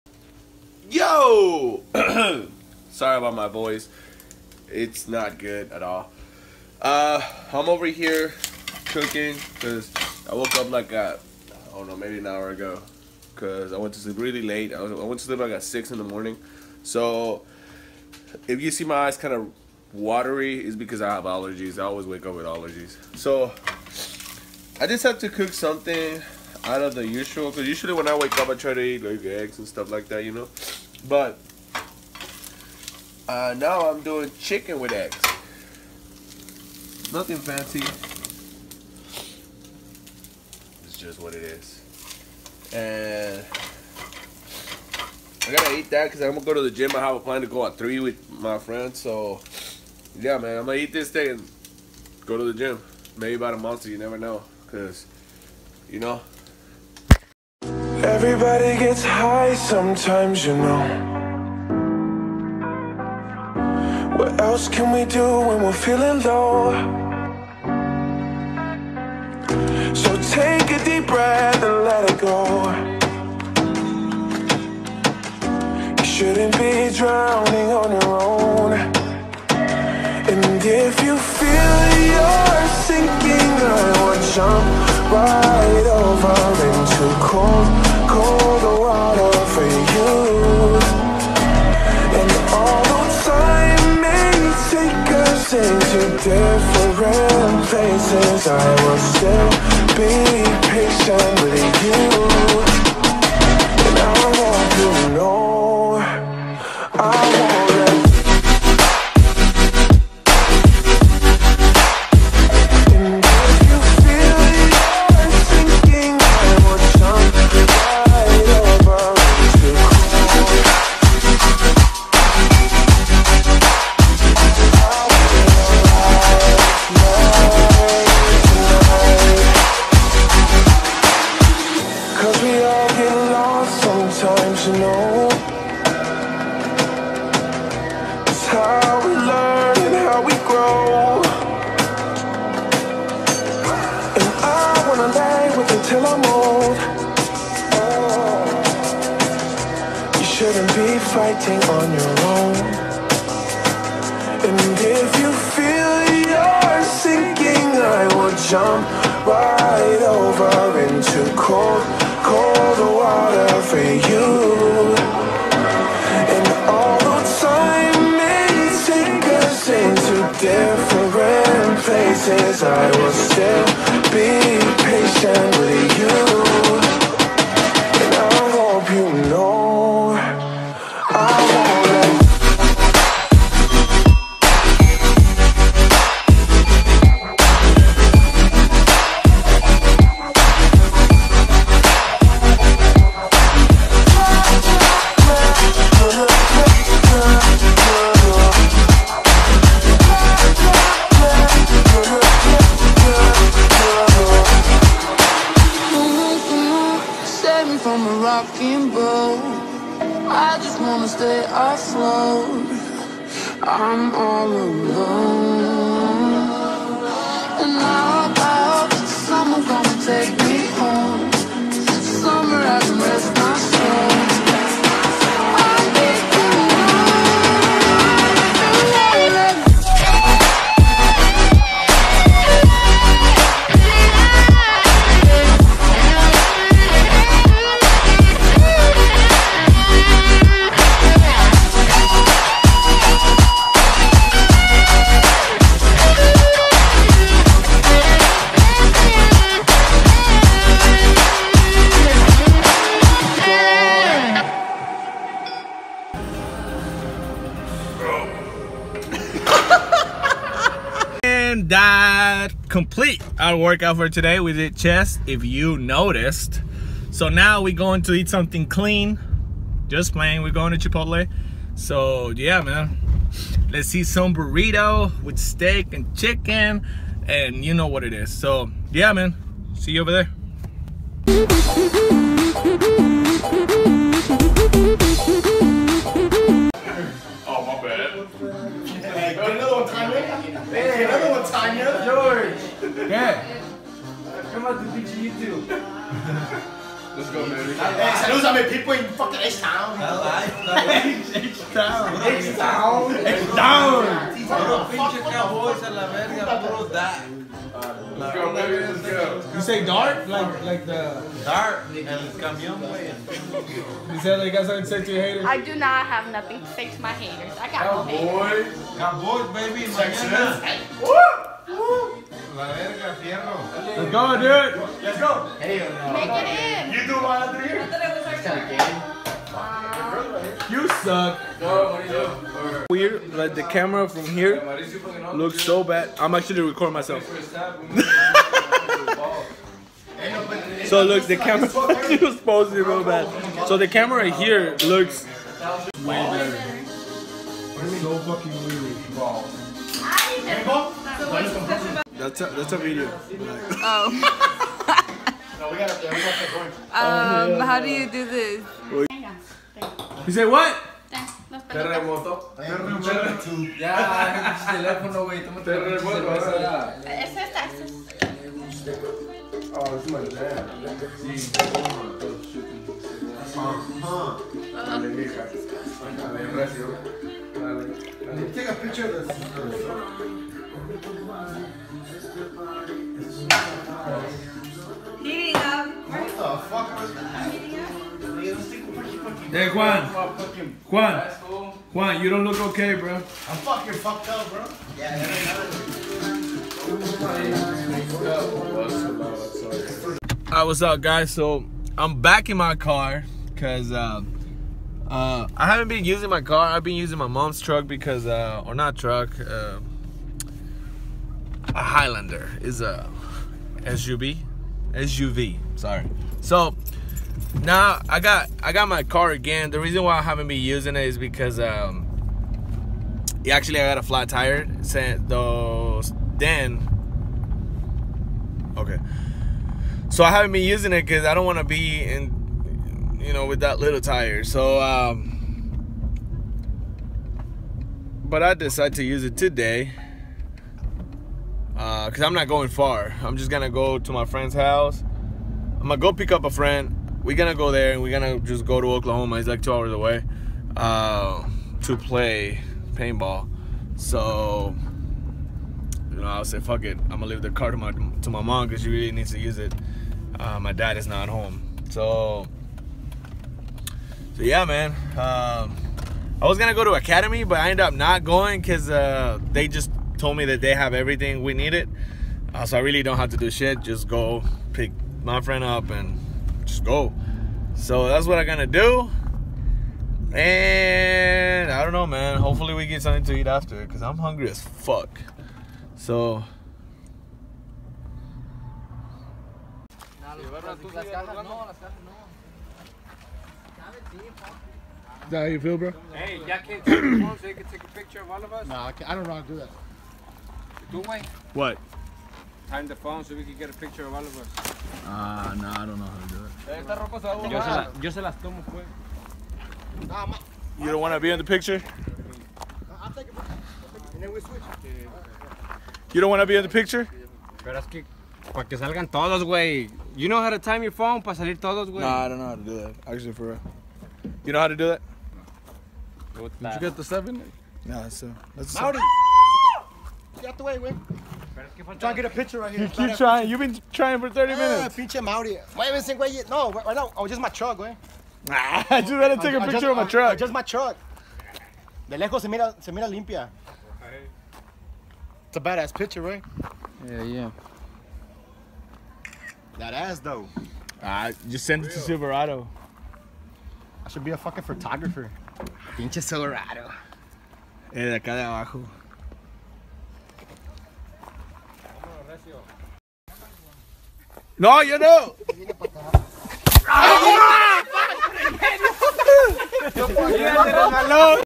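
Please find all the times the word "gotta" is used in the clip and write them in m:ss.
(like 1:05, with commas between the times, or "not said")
0:45.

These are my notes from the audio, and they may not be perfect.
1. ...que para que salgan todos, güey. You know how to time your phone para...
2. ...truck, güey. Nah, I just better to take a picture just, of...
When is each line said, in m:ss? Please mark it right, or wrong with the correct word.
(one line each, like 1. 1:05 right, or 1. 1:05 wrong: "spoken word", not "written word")
1. 8:37 right
2. 8:57 right.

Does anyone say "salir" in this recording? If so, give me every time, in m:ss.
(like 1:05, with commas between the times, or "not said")
8:41.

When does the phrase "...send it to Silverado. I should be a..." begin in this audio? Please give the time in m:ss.
9:11.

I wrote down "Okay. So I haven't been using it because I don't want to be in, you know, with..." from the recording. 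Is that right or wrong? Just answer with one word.
right.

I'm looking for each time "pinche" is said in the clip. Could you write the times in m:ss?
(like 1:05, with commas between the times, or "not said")
5:04, 8:54, 9:15.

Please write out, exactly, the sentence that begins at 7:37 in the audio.
I'm gonna leave the car to my to my mom because she really needs to use it.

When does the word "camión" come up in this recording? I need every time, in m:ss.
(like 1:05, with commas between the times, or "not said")
5:12.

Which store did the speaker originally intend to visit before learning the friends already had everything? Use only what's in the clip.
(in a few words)
Academy.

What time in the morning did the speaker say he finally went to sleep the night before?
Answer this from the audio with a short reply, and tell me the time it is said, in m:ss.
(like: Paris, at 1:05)
6, at 0:15.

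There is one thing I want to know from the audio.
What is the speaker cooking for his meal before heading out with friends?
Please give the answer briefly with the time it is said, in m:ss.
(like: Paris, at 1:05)
chicken with eggs, at 0:34.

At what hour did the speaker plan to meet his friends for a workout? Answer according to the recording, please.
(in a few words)
3.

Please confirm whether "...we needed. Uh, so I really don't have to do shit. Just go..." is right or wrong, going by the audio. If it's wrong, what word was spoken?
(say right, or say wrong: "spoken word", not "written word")
right.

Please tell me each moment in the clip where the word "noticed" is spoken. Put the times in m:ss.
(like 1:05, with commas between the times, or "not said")
4:25.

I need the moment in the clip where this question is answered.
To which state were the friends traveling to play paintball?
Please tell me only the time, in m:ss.
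7:28.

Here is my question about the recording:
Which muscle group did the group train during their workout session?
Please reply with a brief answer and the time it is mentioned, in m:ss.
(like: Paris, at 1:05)
chest, at 4:24.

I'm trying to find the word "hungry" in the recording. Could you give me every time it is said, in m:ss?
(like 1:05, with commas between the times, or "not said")
8:04.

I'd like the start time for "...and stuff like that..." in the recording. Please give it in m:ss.
0:29.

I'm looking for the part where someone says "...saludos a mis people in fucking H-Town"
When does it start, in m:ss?
4:58.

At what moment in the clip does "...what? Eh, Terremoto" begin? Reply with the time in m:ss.
6:00.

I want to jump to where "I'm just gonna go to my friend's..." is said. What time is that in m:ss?
7:23.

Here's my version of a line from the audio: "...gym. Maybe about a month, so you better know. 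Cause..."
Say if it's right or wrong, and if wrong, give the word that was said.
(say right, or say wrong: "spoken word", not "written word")
wrong: "never", not "better".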